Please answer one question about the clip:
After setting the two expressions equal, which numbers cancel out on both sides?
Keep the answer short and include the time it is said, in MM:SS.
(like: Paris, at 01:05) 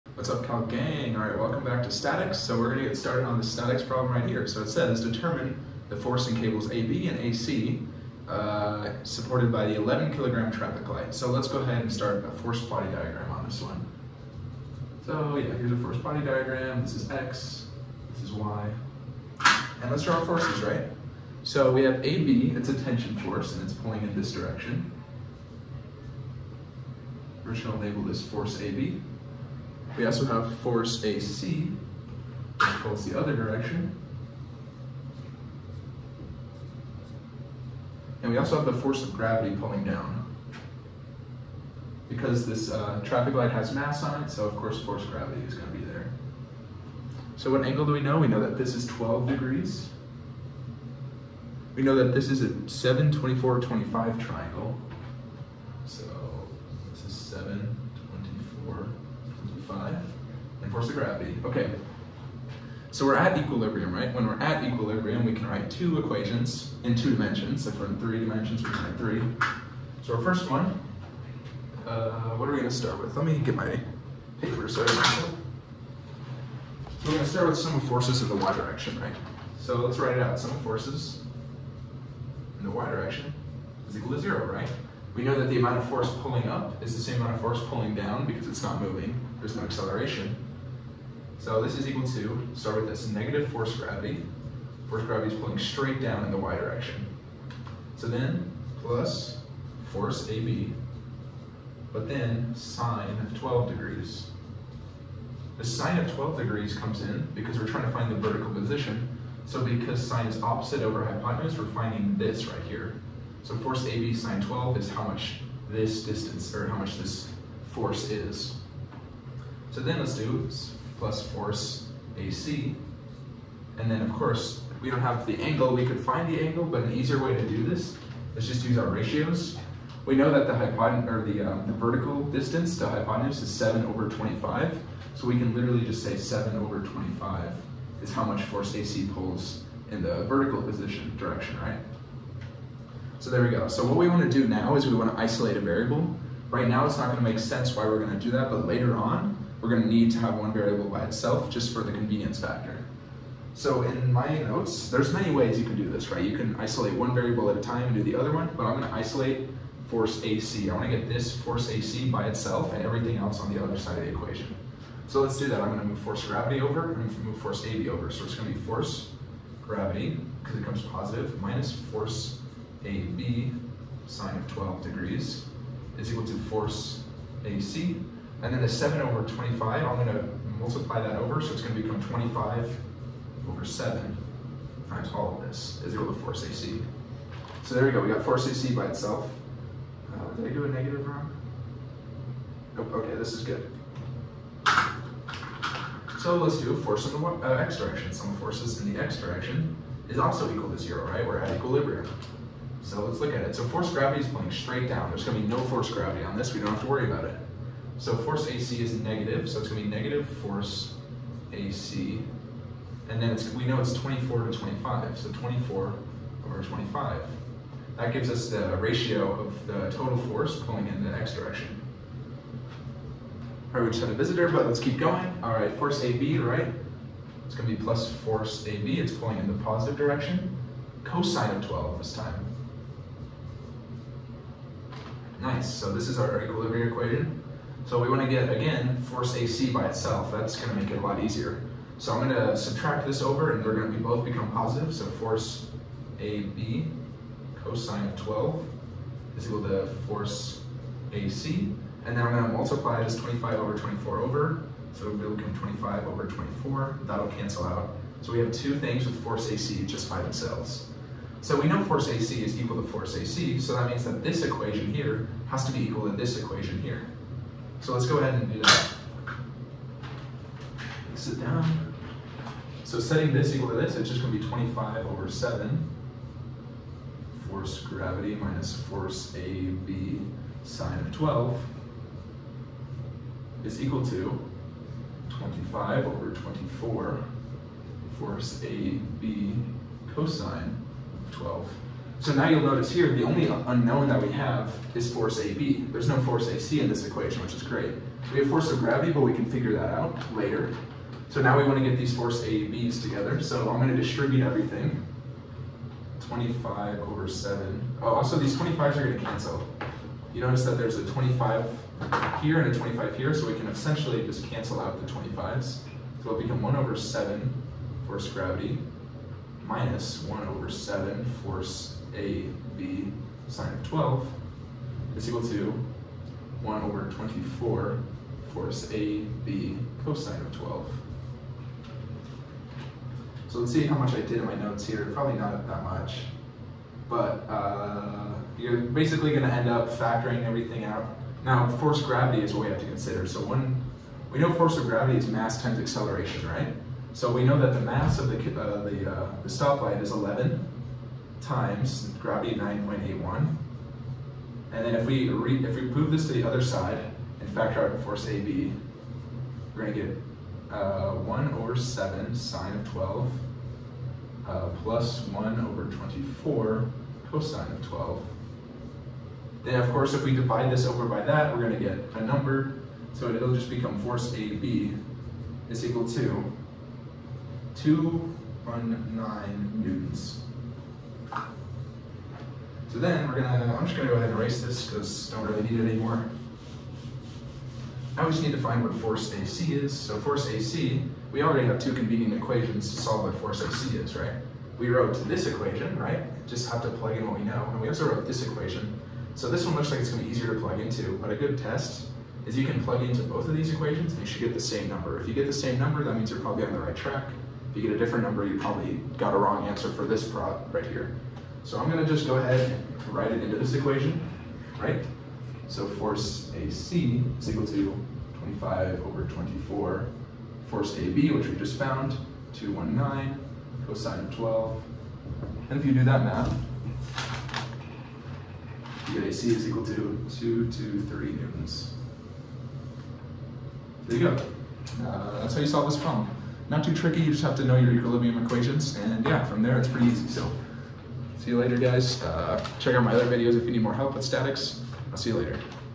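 The 25s, at 05:15.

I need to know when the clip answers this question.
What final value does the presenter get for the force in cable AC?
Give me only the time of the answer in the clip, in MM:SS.
07:09.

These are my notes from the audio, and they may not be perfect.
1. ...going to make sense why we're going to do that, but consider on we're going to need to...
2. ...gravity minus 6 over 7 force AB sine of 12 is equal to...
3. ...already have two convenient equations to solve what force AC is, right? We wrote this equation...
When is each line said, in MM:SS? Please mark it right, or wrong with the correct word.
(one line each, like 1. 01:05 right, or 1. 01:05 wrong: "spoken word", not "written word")
1. 02:27 wrong: "later", not "consider"
2. 05:18 wrong: "1", not "6"
3. 06:31 right.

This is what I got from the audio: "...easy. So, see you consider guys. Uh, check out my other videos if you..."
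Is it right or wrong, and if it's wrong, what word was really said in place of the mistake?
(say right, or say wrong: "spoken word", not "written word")
wrong: "later", not "consider".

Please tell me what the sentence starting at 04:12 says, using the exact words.
And then I'm gonna multiply this 25 over 24 over.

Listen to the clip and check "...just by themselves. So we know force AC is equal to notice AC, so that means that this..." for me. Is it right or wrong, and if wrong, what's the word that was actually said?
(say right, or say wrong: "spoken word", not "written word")
wrong: "force", not "notice".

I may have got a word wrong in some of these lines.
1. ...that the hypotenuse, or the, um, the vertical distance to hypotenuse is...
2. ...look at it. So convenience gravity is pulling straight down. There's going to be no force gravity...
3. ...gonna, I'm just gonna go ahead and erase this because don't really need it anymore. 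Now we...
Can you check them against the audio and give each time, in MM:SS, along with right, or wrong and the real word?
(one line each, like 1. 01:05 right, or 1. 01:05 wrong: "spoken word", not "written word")
1. 02:10 right
2. 03:23 wrong: "force", not "convenience"
3. 06:23 right.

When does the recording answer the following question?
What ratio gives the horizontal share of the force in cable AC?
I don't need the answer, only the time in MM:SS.
03:35.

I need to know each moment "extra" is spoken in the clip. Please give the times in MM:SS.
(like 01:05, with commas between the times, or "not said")
not said.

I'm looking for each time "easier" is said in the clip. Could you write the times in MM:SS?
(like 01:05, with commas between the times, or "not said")
02:06, 04:01, 06:40.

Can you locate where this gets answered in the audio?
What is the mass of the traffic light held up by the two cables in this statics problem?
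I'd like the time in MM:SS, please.
00:09.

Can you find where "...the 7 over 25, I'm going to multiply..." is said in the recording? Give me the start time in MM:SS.
02:58.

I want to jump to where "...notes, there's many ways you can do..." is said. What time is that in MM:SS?
02:34.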